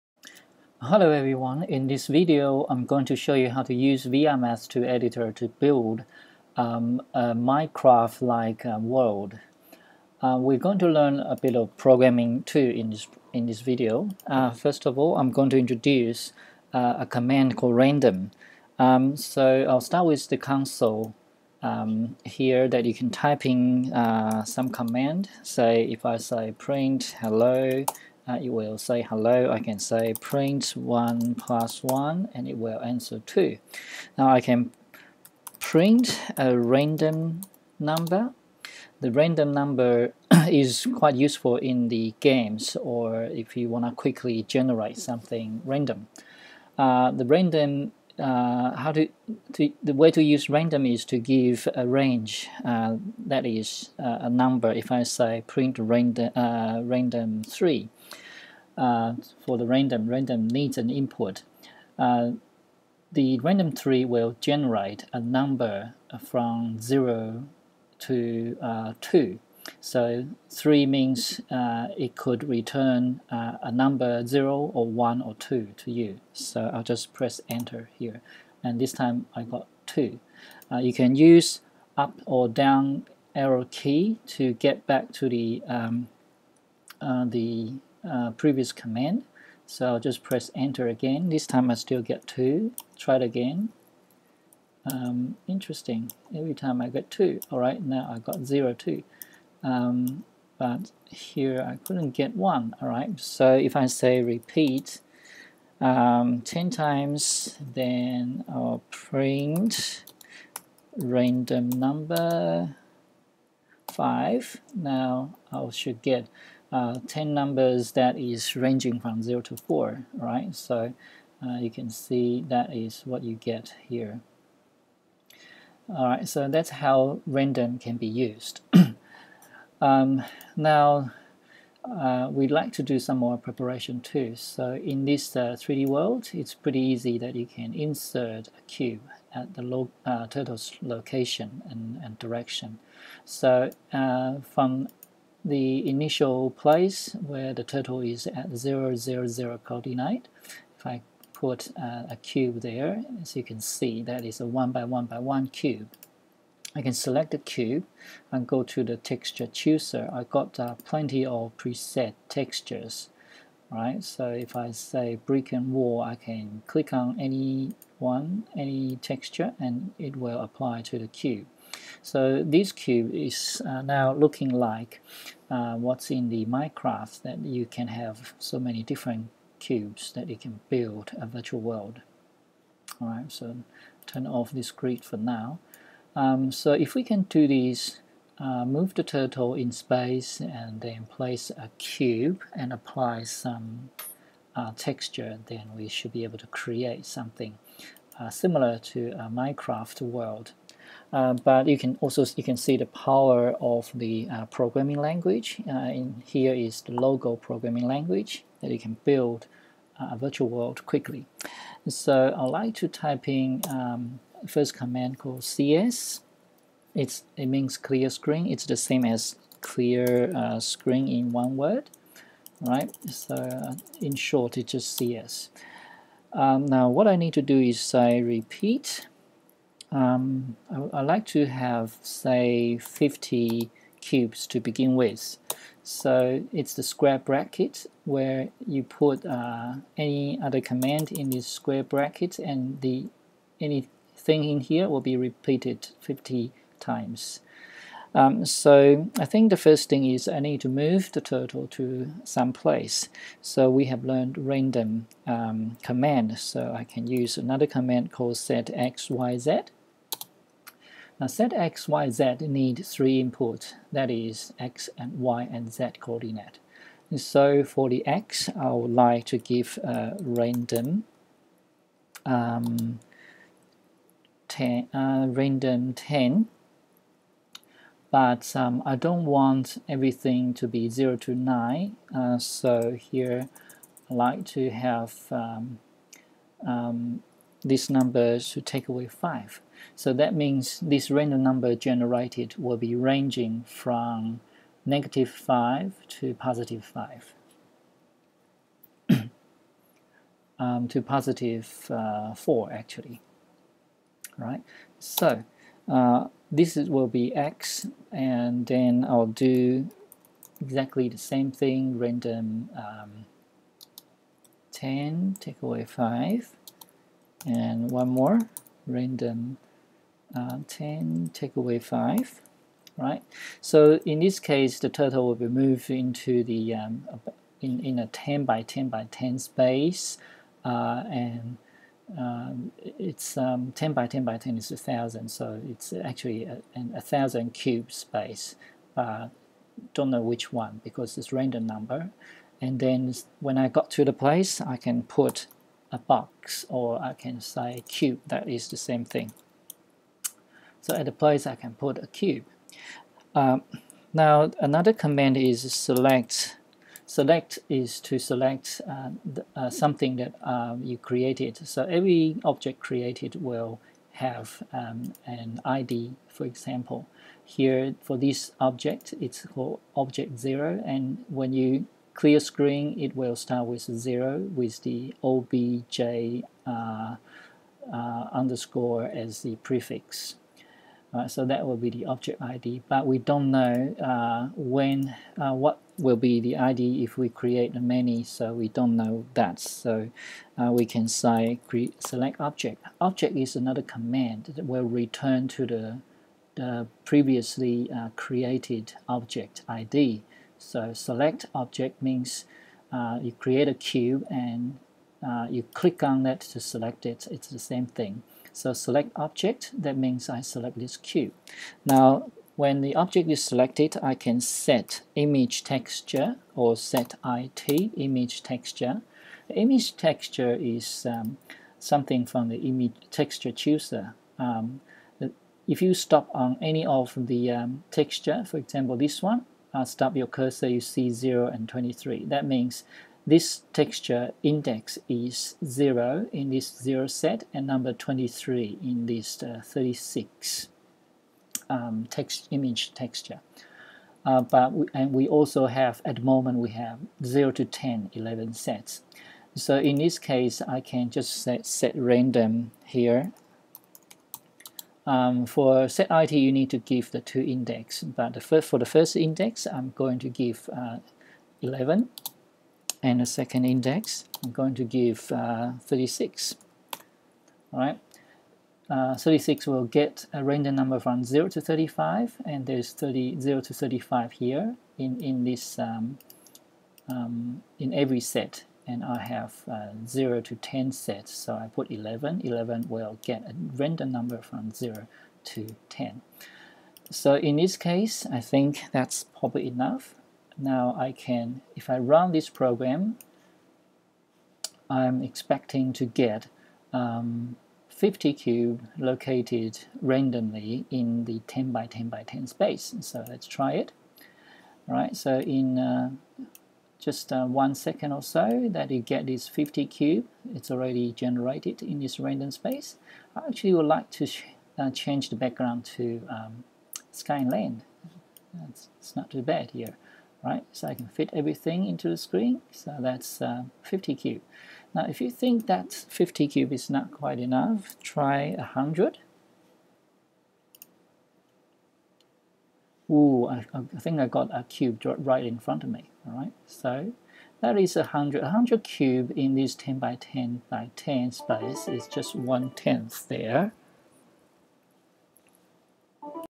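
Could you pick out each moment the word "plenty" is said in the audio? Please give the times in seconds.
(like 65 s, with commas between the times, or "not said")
160 s.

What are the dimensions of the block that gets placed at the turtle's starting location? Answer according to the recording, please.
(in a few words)
1 by 1 by 1.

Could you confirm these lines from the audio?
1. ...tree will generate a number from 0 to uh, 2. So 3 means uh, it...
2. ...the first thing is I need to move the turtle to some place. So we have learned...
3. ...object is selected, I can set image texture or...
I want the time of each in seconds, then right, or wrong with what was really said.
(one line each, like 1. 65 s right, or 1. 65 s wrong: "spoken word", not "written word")
1. 63 s right
2. 249 s right
3. 412 s right.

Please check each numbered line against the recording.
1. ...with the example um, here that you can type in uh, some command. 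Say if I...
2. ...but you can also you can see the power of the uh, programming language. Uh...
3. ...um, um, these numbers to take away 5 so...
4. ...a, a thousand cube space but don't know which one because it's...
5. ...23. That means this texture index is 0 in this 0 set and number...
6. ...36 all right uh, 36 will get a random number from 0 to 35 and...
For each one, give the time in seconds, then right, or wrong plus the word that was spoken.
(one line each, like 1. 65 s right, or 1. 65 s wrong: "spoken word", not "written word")
1. 20 s wrong: "console", not "example"
2. 201 s right
3. 285 s right
4. 336 s right
5. 431 s right
6. 465 s right.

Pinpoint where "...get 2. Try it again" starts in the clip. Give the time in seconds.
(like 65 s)
92 s.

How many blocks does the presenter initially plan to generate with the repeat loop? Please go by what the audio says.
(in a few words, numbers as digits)
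50.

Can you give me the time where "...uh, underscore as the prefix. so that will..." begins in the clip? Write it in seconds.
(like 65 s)
377 s.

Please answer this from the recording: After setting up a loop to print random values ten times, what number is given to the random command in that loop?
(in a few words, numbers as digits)
5.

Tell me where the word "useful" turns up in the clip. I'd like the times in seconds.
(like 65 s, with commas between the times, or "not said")
41 s.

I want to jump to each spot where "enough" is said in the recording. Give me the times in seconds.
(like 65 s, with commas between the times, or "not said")
489 s, 527 s.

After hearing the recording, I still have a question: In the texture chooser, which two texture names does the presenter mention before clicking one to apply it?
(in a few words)
brick and wall.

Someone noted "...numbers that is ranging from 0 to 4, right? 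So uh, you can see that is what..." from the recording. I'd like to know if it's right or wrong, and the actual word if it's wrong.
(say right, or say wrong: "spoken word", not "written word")
right.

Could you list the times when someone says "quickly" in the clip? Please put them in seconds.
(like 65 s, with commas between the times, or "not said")
43 s, 210 s.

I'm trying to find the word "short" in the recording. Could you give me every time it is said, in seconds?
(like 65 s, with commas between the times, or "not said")
224 s.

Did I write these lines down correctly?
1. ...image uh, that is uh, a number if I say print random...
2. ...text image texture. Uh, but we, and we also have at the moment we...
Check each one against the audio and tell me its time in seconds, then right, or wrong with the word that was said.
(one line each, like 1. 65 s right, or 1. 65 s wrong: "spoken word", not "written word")
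1. 51 s wrong: "range", not "image"
2. 442 s right.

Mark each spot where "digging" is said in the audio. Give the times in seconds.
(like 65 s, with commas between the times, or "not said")
not said.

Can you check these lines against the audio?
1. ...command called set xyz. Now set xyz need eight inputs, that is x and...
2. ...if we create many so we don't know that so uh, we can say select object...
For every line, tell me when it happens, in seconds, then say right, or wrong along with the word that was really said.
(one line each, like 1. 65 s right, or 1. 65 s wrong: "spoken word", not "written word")
1. 257 s wrong: "three", not "eight"
2. 387 s right.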